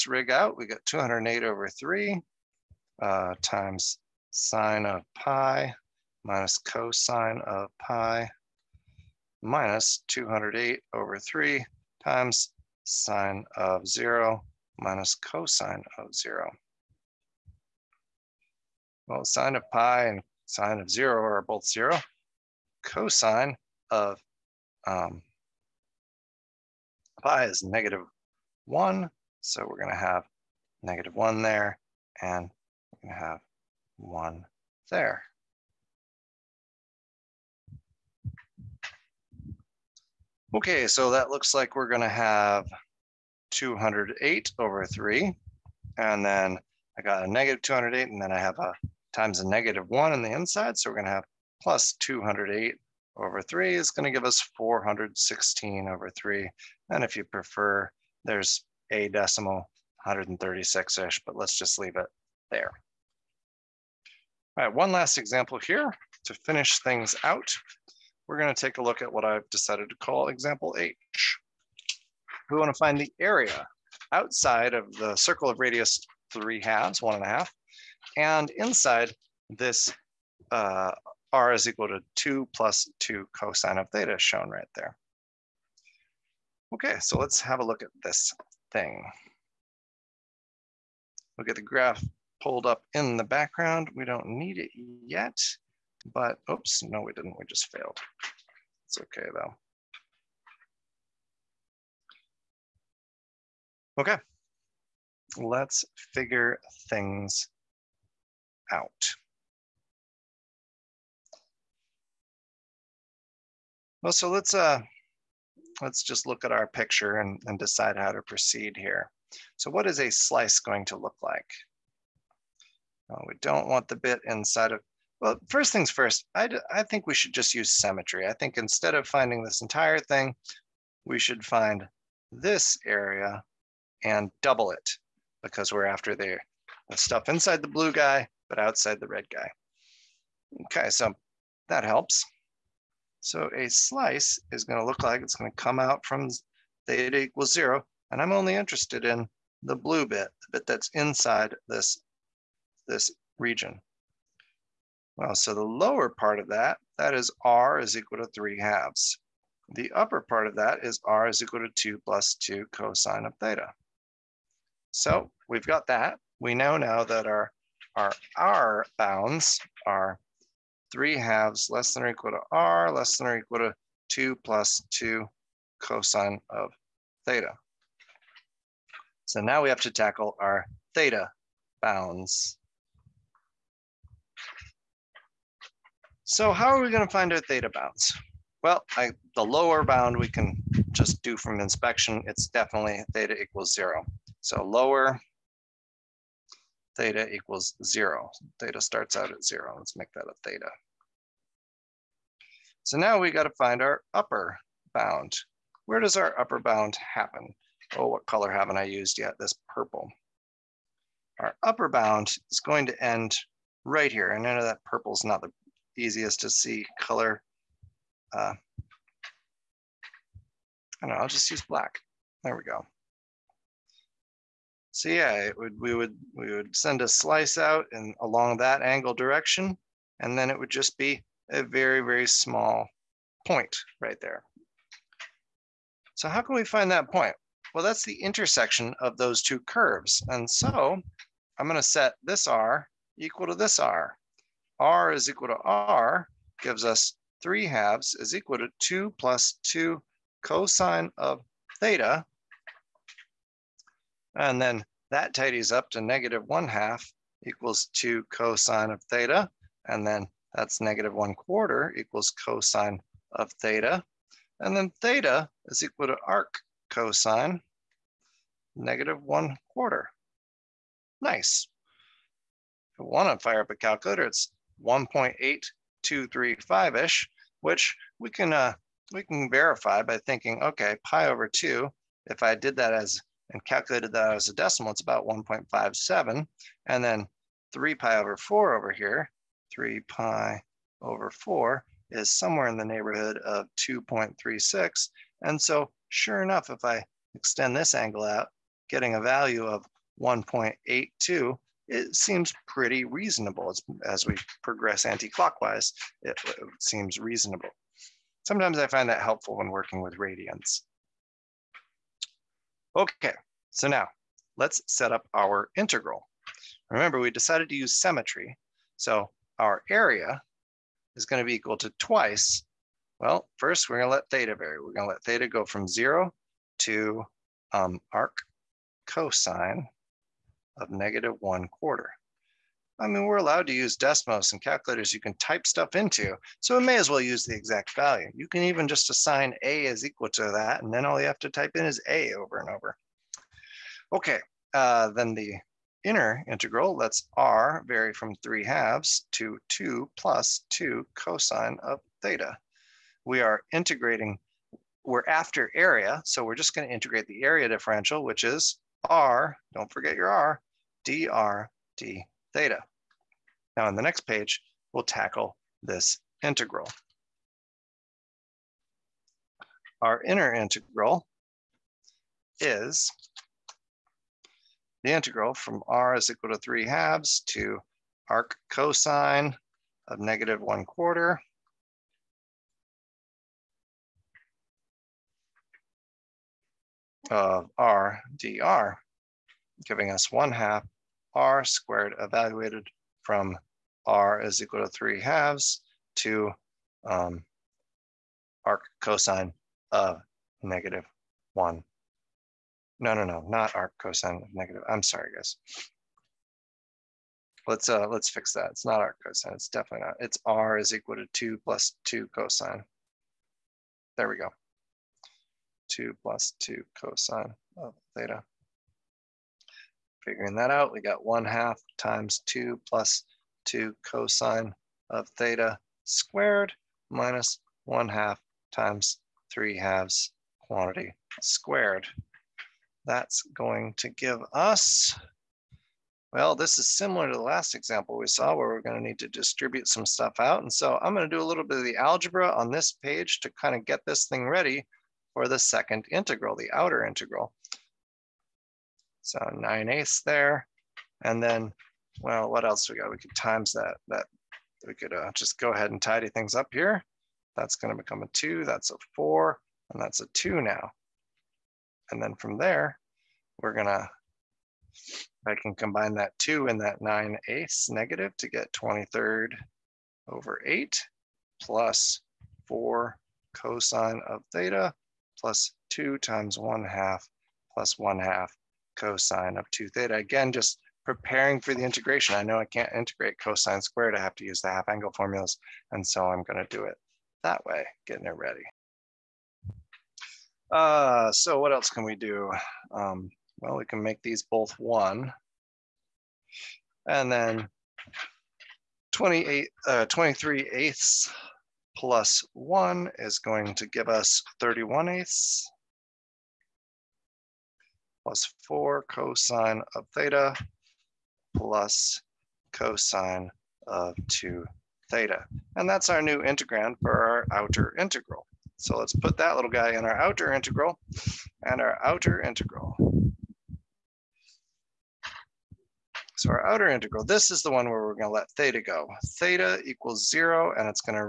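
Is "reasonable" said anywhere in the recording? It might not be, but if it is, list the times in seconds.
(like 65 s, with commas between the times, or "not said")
303 s, 307 s.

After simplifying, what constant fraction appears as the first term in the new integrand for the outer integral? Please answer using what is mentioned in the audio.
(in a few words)
31/8.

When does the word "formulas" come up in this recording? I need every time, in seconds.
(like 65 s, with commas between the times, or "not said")
485 s.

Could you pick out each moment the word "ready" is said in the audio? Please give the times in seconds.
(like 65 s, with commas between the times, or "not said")
444 s, 488 s.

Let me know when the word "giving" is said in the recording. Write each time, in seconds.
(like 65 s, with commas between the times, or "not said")
389 s.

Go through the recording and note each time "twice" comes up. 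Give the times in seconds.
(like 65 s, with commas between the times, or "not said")
321 s.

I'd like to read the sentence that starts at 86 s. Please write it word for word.
Okay, so let's have a look at this thing.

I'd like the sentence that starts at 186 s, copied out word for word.
So how are we going to find our theta bounds?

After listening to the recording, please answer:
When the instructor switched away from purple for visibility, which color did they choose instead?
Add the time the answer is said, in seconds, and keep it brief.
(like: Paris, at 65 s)
black, at 221 s.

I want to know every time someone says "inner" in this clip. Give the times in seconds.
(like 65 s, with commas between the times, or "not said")
346 s, 370 s.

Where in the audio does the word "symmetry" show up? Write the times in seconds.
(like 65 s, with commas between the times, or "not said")
127 s, 317 s.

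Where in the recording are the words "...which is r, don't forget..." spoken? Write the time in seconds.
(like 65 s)
358 s.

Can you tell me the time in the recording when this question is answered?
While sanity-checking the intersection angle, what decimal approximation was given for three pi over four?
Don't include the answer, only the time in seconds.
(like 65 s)
293 s.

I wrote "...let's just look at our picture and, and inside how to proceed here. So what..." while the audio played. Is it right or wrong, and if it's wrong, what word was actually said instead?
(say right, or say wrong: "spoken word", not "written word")
wrong: "decide", not "inside".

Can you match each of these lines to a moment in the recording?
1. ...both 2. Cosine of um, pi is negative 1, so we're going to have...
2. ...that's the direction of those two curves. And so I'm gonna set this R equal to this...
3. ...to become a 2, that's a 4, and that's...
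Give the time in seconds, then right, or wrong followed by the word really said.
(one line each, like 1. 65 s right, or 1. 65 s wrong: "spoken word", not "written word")
1. 21 s wrong: "0", not "2"
2. 237 s wrong: "intersection", not "direction"
3. 457 s right.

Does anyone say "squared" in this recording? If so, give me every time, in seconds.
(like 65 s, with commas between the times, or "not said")
391 s, 426 s, 431 s, 483 s.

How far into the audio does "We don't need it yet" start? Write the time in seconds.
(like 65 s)
93 s.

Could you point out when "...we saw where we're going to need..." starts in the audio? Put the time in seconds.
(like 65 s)
438 s.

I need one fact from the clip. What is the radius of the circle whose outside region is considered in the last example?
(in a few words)
3/2.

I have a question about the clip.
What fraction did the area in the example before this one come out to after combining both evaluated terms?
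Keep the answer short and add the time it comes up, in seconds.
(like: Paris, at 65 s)
416/3, at 54 s.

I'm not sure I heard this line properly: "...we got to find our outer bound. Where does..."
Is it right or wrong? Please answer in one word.
wrong.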